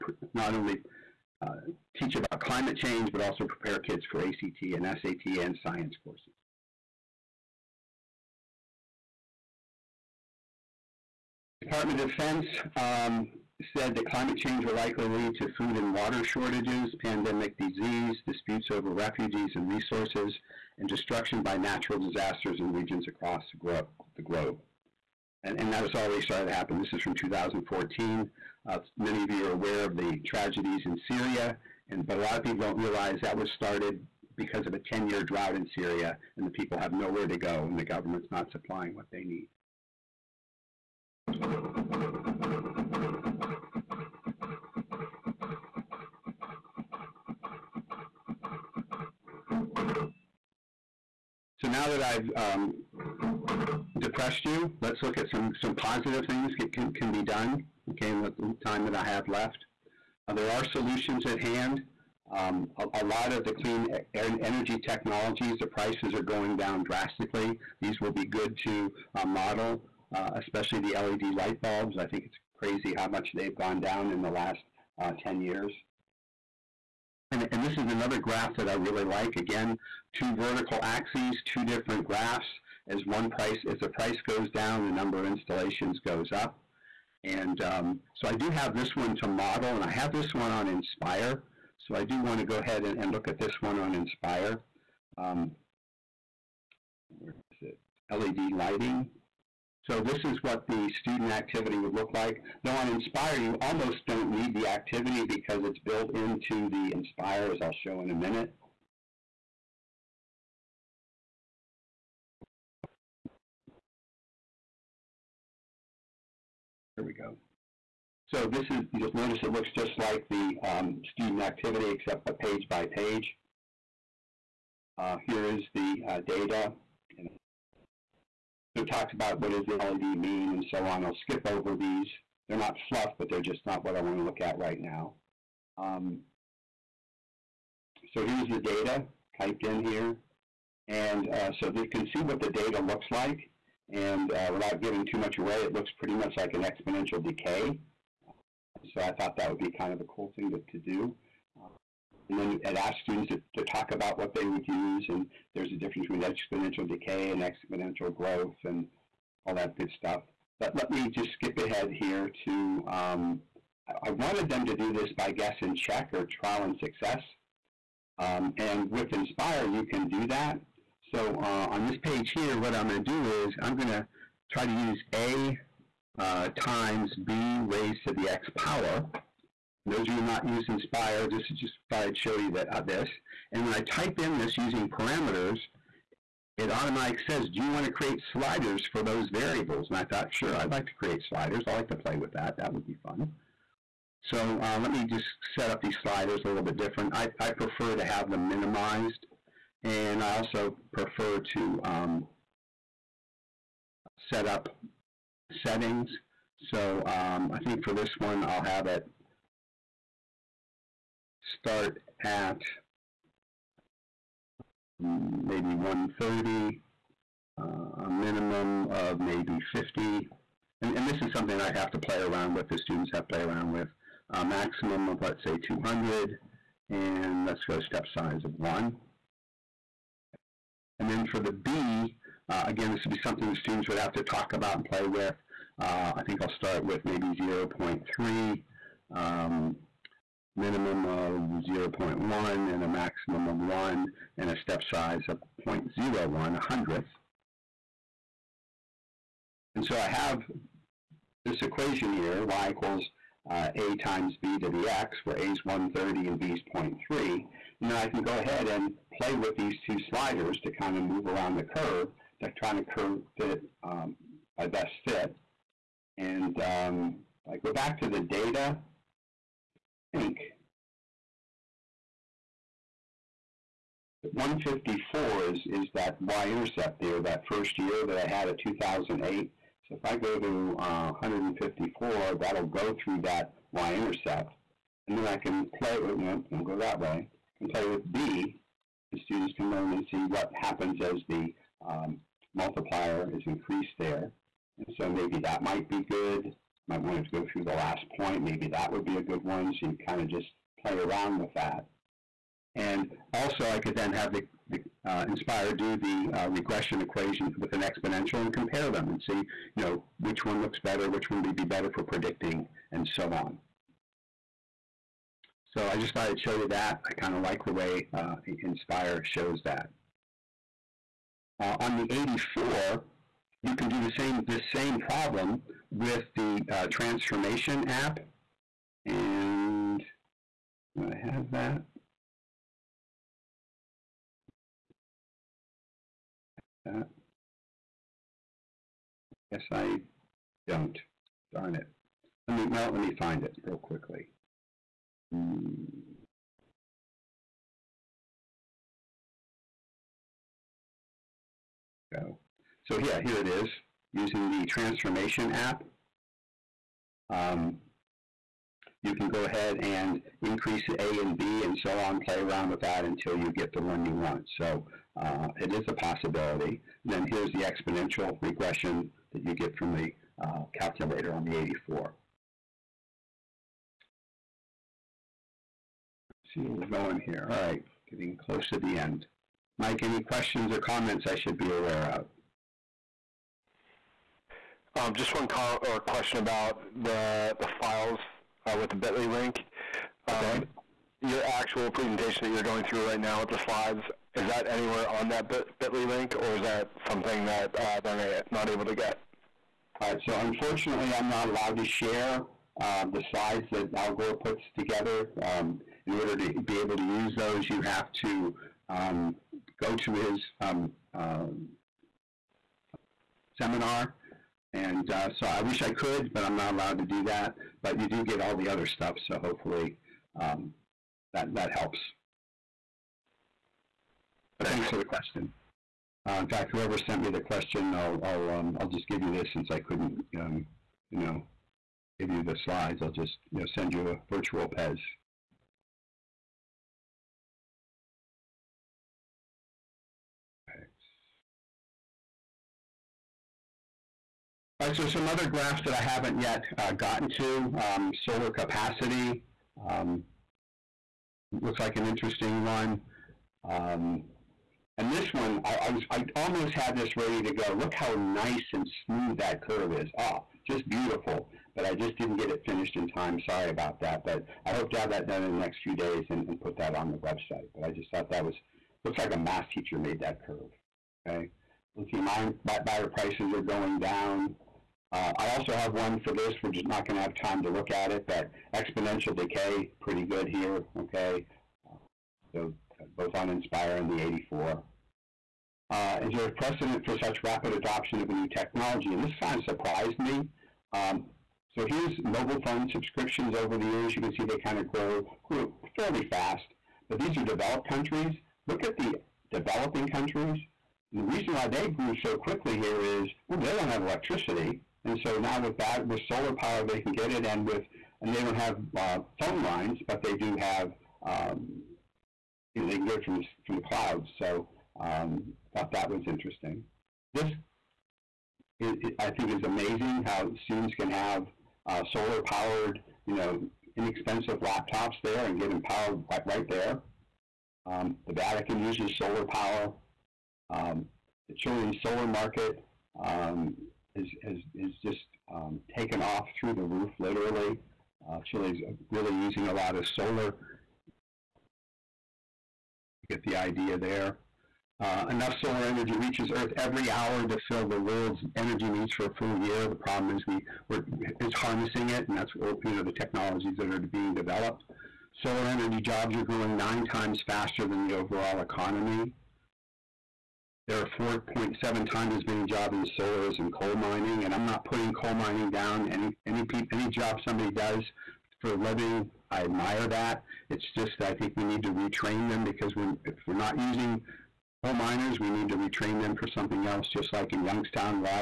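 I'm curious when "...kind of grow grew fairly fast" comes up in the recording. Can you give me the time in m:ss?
8:14.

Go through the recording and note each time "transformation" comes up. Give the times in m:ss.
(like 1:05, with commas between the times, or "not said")
5:26, 5:54.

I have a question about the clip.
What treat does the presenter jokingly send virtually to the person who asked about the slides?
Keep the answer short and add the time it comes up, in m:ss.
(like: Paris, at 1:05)
Pez, at 7:14.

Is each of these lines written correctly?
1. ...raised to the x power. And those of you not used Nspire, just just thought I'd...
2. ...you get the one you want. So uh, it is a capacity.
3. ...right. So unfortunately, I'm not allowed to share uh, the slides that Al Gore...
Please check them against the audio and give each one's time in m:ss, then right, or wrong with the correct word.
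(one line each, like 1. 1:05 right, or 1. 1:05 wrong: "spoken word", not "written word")
1. 2:57 right
2. 6:03 wrong: "possibility", not "capacity"
3. 6:40 right.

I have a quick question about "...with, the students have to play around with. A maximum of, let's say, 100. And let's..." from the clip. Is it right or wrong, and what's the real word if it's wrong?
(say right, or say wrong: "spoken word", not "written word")
wrong: "200", not "100".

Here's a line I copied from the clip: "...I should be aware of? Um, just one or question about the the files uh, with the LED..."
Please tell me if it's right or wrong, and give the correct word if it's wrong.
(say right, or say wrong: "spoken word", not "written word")
wrong: "Bitly", not "LED".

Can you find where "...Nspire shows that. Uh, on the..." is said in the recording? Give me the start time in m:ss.
5:18.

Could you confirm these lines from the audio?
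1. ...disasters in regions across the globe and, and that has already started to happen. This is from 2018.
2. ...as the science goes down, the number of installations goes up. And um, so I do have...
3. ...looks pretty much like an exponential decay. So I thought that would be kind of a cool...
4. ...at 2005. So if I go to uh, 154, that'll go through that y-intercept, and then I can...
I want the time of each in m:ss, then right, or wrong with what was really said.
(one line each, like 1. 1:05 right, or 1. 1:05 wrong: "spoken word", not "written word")
1. 0:21 wrong: "2014", not "2018"
2. 1:23 wrong: "price", not "science"
3. 2:25 right
4. 4:38 wrong: "2008", not "2005".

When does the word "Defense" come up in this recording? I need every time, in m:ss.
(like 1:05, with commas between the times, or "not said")
0:12.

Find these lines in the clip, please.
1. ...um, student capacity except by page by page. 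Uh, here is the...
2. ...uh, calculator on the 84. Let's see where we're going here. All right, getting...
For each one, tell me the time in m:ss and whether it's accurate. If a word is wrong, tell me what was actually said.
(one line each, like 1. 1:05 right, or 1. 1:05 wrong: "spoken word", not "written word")
1. 2:00 wrong: "activity", not "capacity"
2. 6:10 right.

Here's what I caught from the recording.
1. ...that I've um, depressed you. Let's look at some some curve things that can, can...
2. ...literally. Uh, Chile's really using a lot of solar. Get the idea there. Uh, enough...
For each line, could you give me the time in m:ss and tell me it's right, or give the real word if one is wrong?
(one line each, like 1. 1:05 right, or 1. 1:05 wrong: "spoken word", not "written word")
1. 0:51 wrong: "positive", not "curve"
2. 8:57 right.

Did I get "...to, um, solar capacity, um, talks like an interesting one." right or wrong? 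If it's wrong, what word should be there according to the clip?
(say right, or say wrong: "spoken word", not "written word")
wrong: "looks", not "talks".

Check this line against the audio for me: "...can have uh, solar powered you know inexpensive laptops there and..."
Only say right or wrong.
right.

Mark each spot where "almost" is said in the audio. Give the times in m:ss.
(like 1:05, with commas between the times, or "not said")
1:43, 7:36.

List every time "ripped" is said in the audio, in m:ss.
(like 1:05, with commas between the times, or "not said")
not said.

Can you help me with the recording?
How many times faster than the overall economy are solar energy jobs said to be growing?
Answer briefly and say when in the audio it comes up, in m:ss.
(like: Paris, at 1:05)
9, at 9:16.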